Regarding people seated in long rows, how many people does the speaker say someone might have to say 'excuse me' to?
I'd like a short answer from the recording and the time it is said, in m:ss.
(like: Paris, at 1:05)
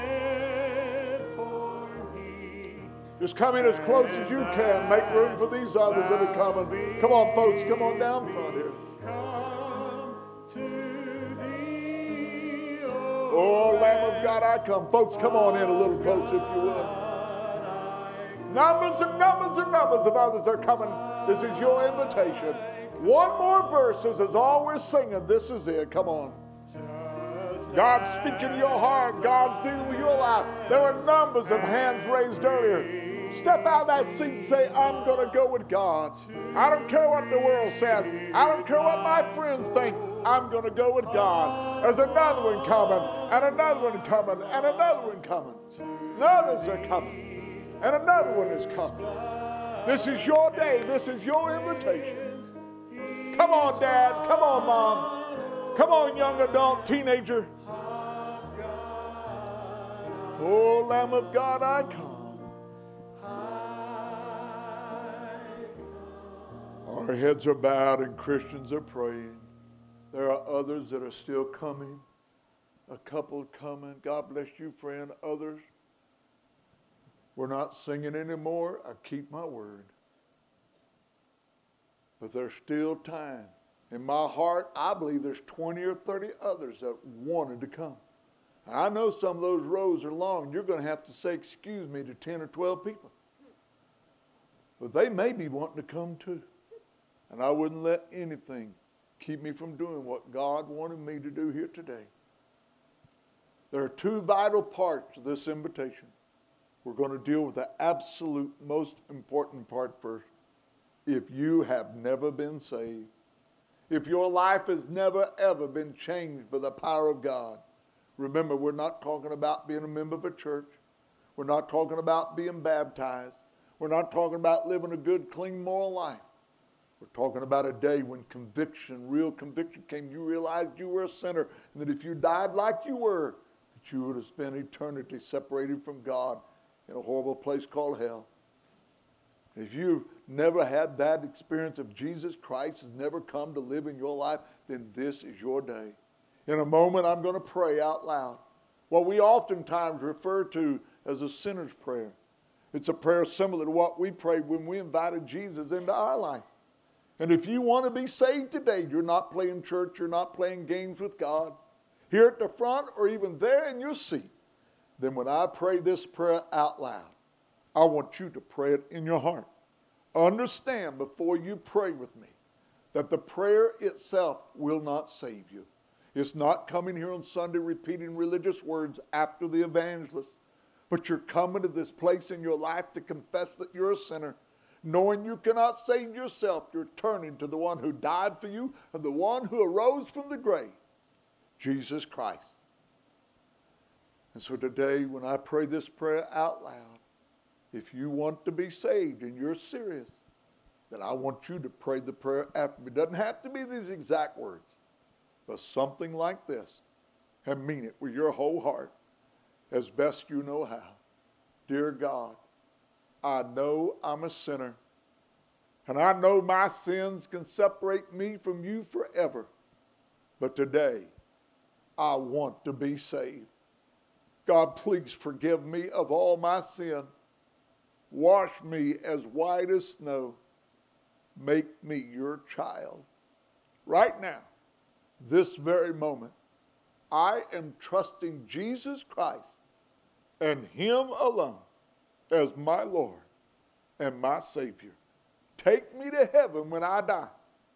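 10 or 12, at 1:32.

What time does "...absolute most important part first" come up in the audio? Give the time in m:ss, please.
1:47.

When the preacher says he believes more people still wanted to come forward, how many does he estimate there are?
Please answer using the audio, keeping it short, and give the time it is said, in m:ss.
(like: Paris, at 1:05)
20 or 30, at 1:25.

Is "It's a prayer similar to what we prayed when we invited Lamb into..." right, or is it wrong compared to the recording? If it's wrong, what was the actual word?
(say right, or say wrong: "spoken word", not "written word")
wrong: "Jesus", not "Lamb".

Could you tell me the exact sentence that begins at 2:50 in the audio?
Understand before you pray with me that the prayer itself will not save you.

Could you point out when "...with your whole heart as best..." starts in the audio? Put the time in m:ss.
3:28.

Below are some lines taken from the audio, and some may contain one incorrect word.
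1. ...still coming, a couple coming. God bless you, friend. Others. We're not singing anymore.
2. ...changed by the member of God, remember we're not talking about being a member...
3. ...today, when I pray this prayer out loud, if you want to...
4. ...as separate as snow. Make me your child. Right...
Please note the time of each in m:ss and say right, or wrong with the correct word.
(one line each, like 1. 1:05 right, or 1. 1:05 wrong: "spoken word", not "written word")
1. 1:11 right
2. 1:55 wrong: "power", not "member"
3. 3:14 right
4. 3:49 wrong: "white", not "separate".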